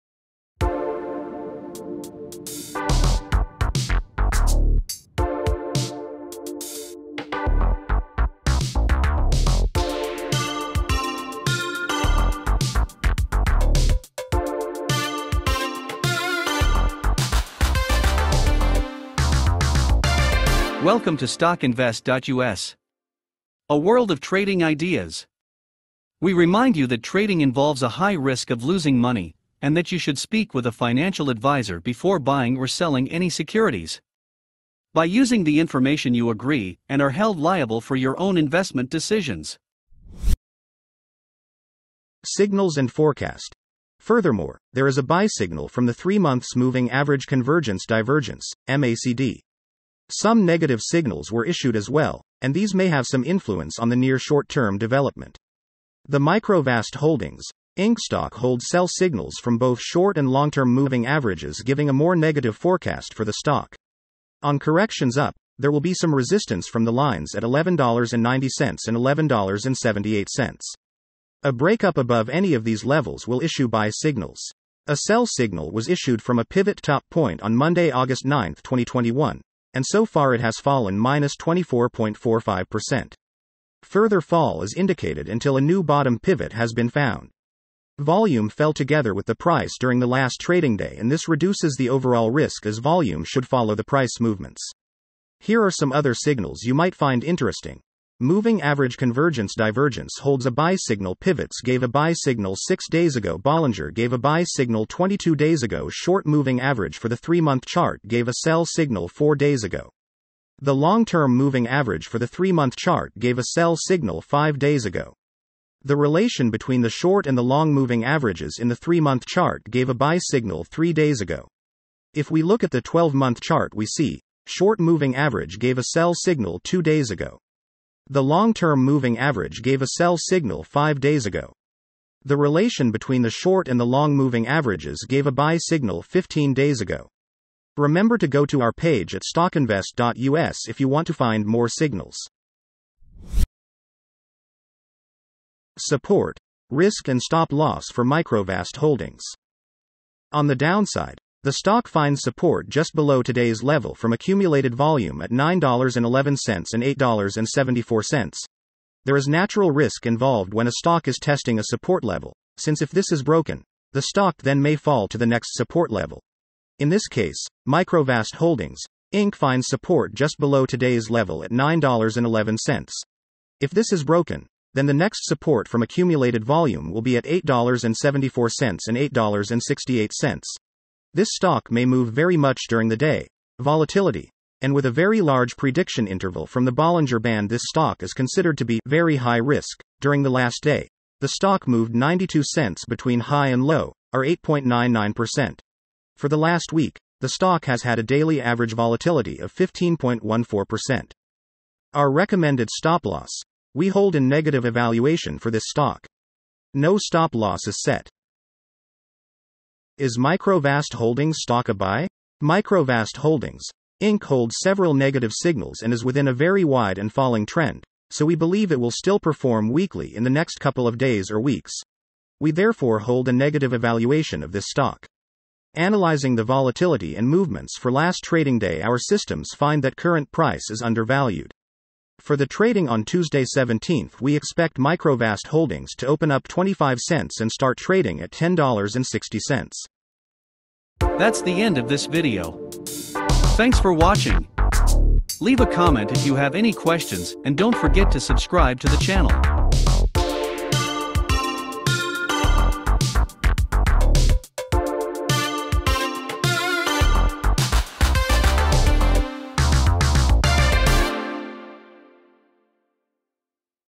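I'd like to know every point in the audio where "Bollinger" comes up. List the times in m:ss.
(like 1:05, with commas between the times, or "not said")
1:43, 3:06.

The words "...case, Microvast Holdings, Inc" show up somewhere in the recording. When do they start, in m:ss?
2:47.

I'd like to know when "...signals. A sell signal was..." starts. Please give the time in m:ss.
1:13.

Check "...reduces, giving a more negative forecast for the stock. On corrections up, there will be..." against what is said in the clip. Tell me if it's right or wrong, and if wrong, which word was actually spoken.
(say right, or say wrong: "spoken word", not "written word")
wrong: "averages", not "reduces".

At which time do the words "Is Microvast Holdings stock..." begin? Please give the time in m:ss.
3:30.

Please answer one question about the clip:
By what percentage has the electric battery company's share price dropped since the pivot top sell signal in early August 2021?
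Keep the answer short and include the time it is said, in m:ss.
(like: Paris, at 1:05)
24.45%, at 1:21.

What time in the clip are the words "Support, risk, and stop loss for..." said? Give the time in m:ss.
2:25.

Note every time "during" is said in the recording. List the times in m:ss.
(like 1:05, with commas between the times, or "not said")
1:29, 3:02, 3:09.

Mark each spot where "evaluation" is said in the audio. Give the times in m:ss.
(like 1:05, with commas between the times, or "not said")
3:24, 3:43.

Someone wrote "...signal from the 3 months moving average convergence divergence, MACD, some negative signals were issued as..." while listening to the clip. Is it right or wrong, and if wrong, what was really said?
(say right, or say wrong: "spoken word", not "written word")
right.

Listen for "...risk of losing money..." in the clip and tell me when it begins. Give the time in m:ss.
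0:28.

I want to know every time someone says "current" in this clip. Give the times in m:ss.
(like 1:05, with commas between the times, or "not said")
3:49.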